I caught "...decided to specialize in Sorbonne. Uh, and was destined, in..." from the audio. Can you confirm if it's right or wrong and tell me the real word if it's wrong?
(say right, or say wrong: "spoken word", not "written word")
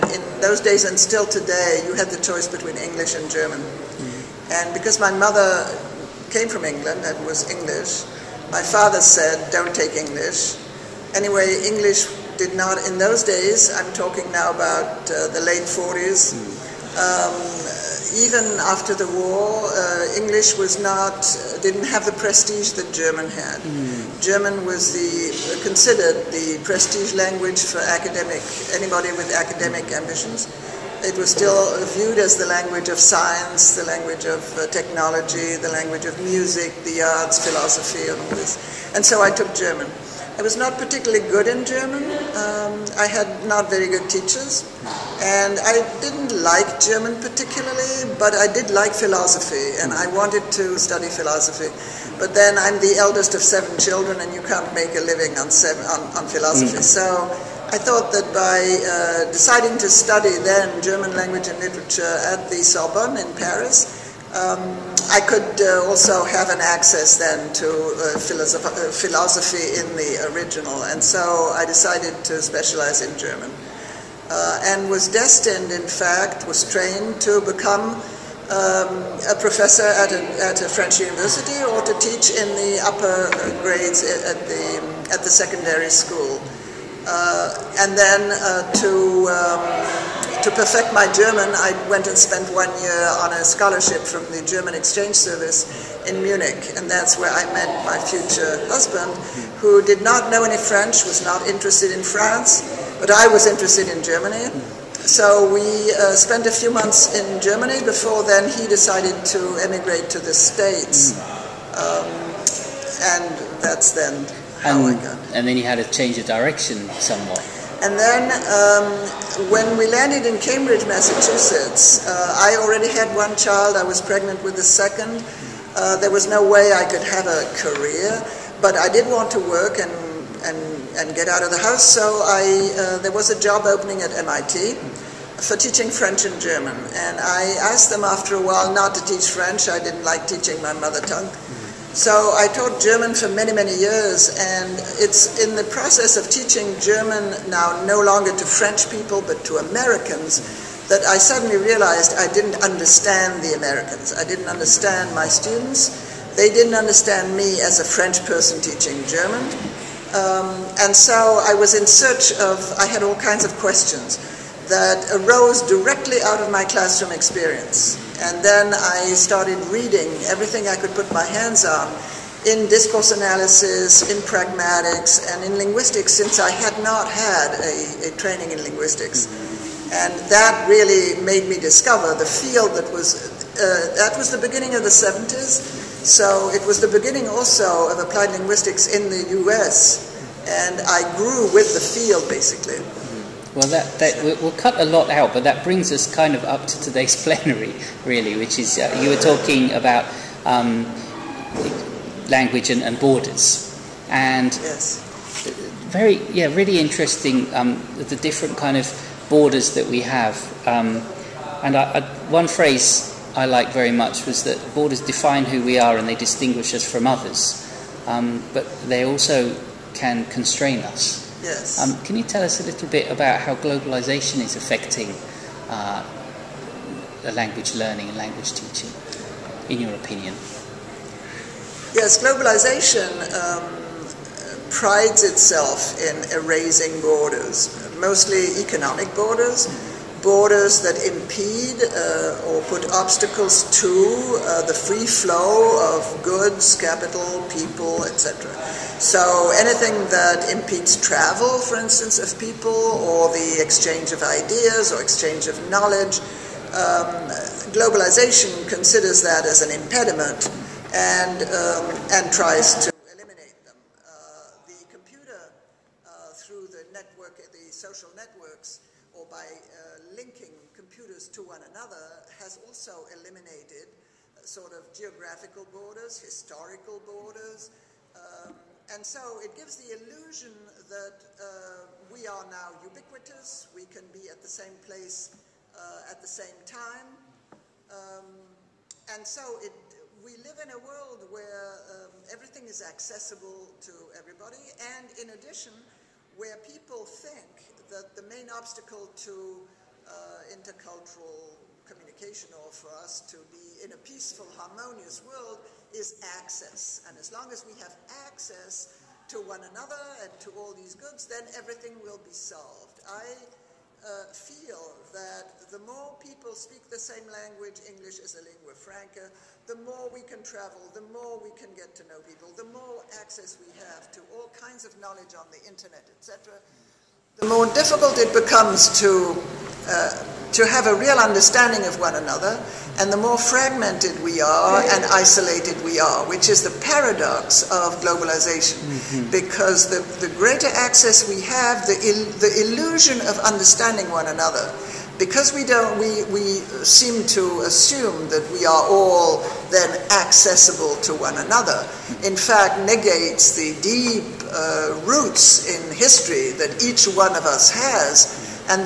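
wrong: "German", not "Sorbonne".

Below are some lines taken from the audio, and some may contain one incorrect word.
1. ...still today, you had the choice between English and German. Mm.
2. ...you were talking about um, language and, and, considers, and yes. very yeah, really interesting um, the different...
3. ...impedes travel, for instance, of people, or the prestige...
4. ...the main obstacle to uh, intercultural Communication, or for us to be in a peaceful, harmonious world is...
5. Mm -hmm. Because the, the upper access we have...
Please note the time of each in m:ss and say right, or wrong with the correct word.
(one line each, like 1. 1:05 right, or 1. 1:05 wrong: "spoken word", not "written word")
1. 0:00 right
2. 3:18 wrong: "borders", not "considers"
3. 4:10 wrong: "exchange", not "prestige"
4. 4:58 right
5. 5:38 wrong: "greater", not "upper".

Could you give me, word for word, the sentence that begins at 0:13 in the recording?
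I'm talking now about uh, the late 40s.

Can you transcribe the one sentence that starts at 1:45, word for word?
So we uh, spent a few months in Germany.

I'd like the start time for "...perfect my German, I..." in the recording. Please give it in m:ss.
1:30.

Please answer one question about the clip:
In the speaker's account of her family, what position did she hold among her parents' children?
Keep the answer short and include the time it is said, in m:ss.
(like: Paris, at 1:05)
Eldest of 7, at 0:52.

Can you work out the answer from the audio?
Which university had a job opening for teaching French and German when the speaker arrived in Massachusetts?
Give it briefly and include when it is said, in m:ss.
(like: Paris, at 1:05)
MIT, at 2:14.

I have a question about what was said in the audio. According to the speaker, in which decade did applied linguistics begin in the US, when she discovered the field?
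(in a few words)
The 70s.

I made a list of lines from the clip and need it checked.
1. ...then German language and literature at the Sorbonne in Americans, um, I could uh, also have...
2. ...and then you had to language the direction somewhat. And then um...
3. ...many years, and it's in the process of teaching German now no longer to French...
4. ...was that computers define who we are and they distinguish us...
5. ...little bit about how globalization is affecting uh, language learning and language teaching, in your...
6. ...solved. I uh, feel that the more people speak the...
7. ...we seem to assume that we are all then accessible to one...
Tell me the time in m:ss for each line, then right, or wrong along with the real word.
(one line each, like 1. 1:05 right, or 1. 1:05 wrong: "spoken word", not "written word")
1. 1:00 wrong: "Paris", not "Americans"
2. 1:55 wrong: "change", not "language"
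3. 2:23 right
4. 3:34 wrong: "borders", not "computers"
5. 3:42 right
6. 5:12 right
7. 5:46 right.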